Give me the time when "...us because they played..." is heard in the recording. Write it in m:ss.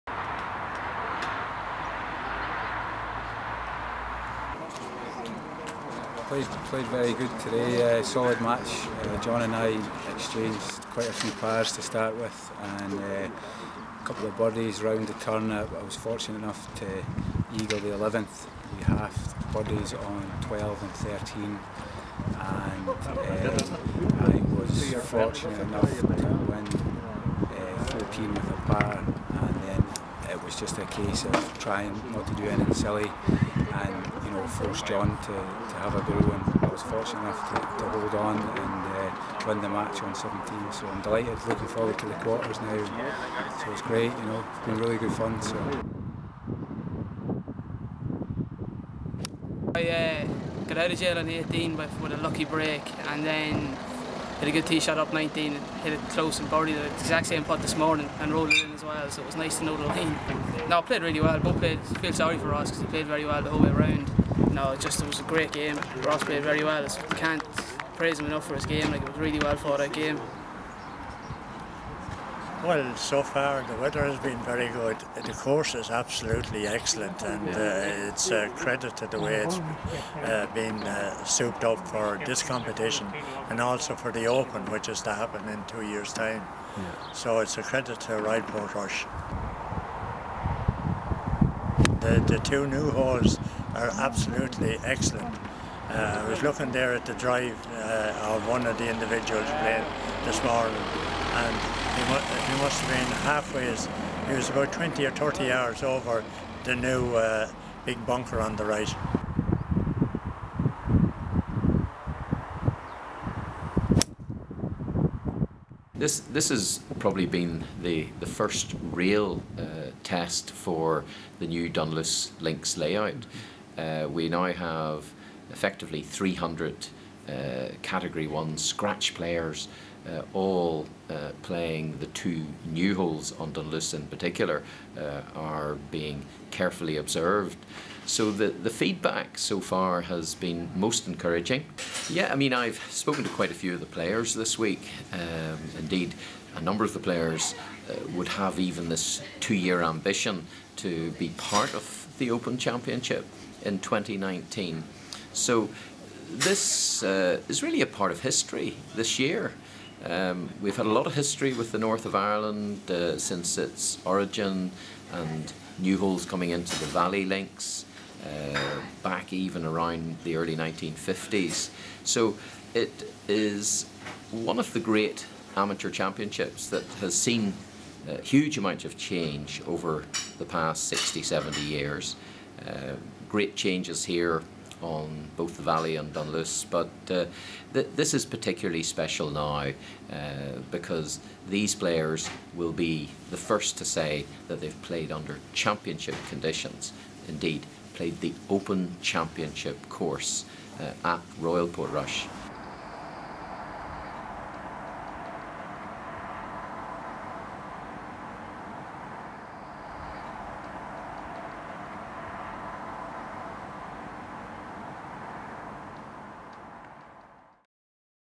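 1:02.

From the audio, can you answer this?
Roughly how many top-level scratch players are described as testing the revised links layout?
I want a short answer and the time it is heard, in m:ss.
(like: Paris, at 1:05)
300, at 2:06.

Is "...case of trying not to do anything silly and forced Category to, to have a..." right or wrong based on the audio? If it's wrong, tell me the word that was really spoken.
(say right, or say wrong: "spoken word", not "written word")
wrong: "John", not "Category".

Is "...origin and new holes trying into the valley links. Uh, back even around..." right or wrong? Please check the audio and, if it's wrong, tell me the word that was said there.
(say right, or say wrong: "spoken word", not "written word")
wrong: "coming", not "trying".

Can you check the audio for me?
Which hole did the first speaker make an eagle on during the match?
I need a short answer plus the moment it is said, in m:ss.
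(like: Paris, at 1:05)
11th, at 0:17.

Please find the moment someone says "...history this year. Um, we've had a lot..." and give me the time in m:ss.
2:38.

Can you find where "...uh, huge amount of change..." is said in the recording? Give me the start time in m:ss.
2:58.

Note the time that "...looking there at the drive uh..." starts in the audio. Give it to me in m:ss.
1:36.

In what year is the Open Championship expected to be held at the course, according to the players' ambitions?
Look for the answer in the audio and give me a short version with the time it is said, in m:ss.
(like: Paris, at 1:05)
2019, at 2:33.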